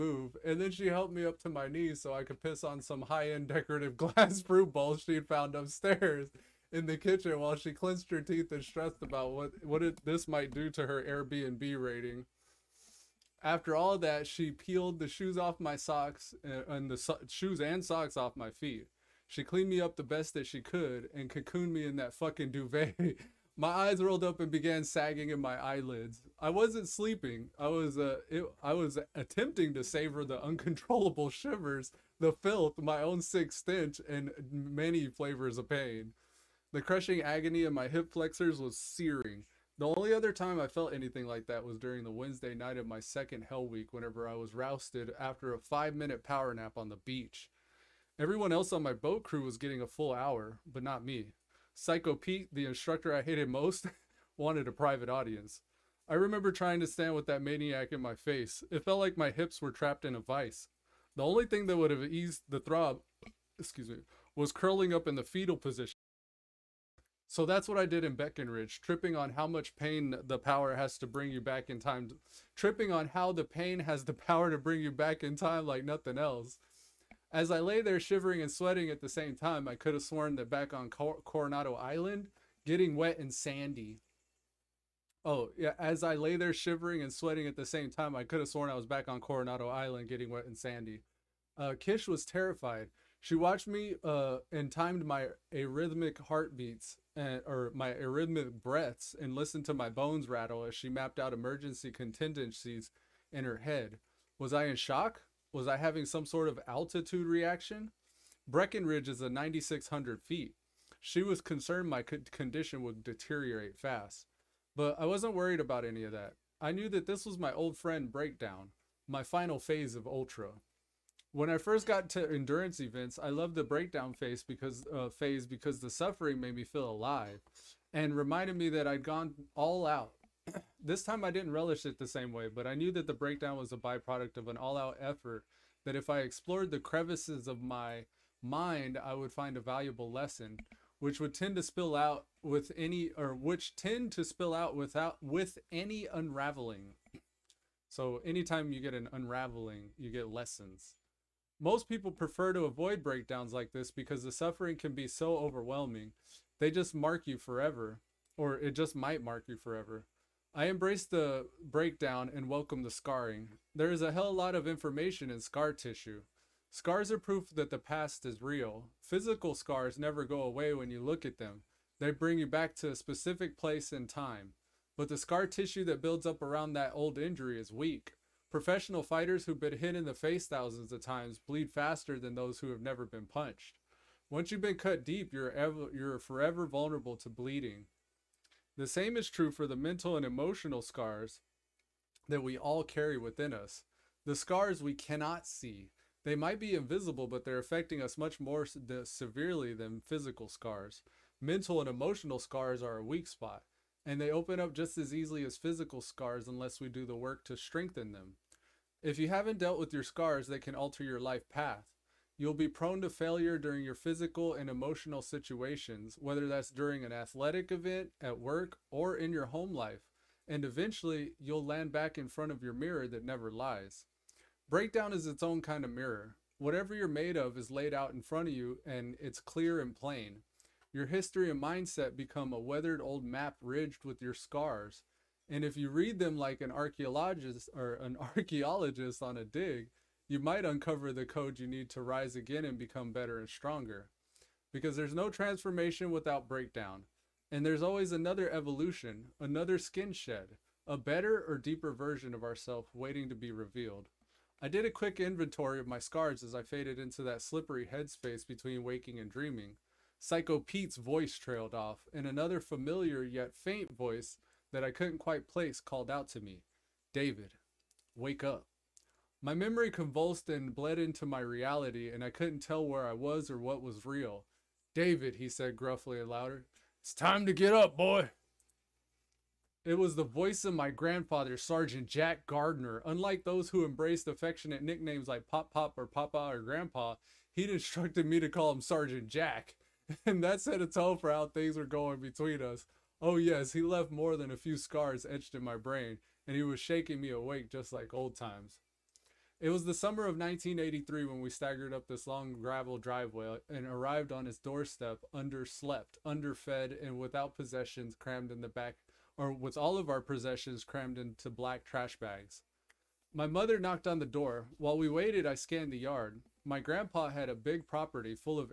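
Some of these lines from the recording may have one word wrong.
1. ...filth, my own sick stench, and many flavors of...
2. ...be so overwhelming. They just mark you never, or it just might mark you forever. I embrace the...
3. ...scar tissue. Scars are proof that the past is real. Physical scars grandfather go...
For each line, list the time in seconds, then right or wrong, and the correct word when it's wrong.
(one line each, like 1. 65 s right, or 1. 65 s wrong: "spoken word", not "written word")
1. 32 s right
2. 154 s wrong: "forever", not "never"
3. 165 s wrong: "never", not "grandfather".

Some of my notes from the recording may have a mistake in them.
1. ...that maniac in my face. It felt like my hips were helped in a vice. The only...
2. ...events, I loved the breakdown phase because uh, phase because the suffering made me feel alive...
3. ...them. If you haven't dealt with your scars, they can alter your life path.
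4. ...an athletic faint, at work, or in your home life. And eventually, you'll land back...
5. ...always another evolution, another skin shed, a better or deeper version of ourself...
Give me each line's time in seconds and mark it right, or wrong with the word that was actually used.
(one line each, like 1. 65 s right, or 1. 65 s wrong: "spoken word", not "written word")
1. 57 s wrong: "trapped", not "helped"
2. 122 s right
3. 208 s right
4. 217 s wrong: "event", not "faint"
5. 247 s right.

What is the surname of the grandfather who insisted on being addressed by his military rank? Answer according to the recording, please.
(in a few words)
Gardner.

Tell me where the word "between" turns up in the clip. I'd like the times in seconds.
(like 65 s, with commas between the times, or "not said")
258 s, 292 s.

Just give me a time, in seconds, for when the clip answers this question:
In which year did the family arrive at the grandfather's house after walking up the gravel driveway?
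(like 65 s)
300 s.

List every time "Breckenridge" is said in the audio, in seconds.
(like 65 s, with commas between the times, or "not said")
68 s, 108 s.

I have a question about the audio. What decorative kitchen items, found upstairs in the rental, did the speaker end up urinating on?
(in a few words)
glass fruit bowls.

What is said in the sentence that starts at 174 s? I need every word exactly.
But the scar tissue that builds up around that old injury is weak.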